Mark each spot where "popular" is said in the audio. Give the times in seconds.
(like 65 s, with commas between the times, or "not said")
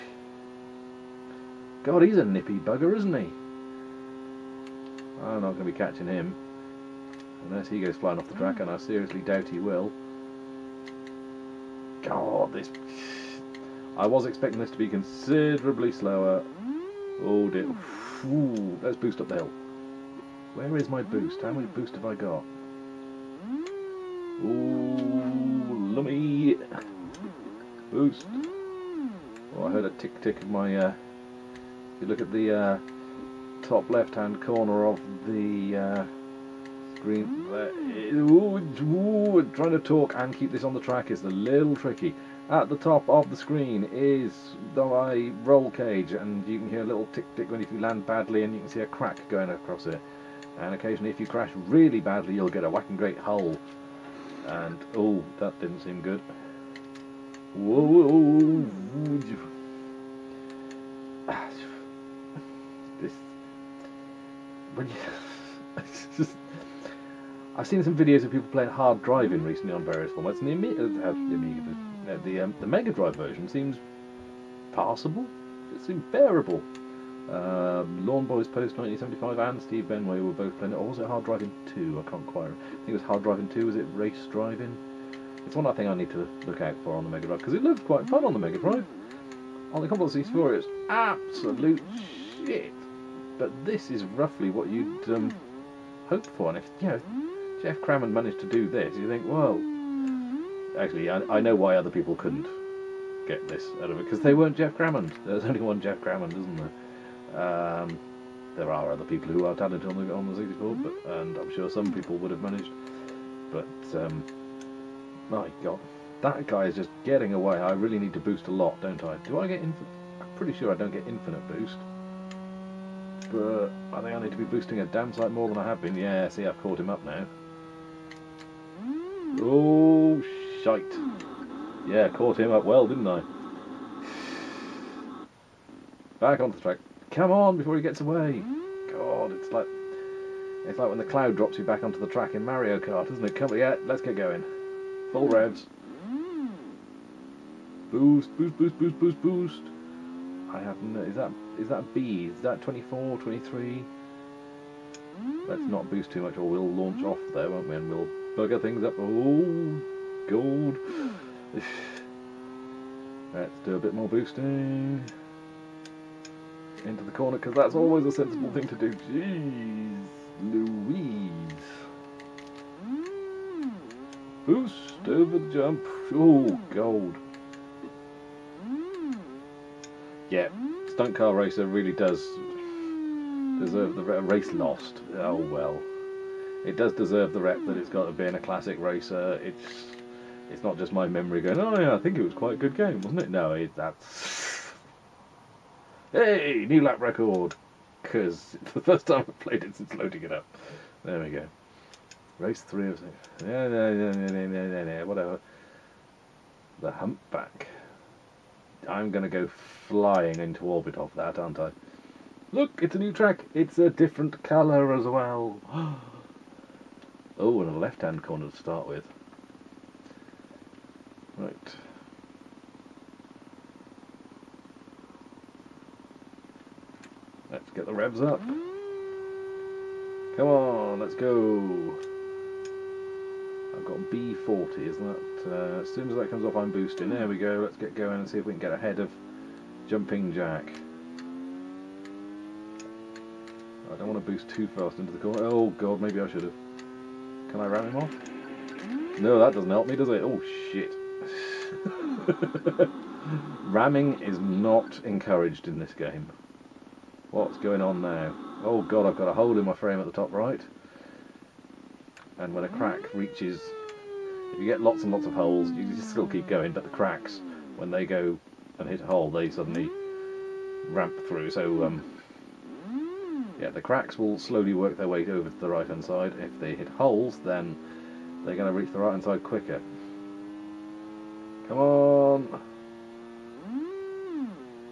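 not said.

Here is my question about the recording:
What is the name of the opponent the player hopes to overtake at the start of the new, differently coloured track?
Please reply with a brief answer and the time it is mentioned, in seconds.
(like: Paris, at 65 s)
Jumping Jack, at 239 s.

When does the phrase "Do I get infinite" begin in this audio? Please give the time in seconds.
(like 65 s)
119 s.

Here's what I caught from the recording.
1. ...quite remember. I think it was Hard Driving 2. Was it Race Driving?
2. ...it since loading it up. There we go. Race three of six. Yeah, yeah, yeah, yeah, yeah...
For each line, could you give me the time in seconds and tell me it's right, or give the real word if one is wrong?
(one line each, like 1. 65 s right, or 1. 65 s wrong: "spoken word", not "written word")
1. 82 s right
2. 199 s right.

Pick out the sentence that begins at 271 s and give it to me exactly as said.
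So, um, yeah, the cracks will slowly work their way over to the right-hand side.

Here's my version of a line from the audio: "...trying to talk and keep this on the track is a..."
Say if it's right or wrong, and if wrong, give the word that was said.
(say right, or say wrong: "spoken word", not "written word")
right.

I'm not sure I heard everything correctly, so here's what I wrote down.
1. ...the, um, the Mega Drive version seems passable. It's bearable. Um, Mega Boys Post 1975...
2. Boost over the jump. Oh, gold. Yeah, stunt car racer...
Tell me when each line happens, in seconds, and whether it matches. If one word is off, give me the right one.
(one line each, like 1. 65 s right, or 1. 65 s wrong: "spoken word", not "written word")
1. 72 s wrong: "Lawn", not "Mega"
2. 174 s right.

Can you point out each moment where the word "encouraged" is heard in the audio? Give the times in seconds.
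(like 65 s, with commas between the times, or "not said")
255 s.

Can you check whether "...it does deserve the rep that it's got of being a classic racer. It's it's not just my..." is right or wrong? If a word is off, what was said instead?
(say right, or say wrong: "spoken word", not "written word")
right.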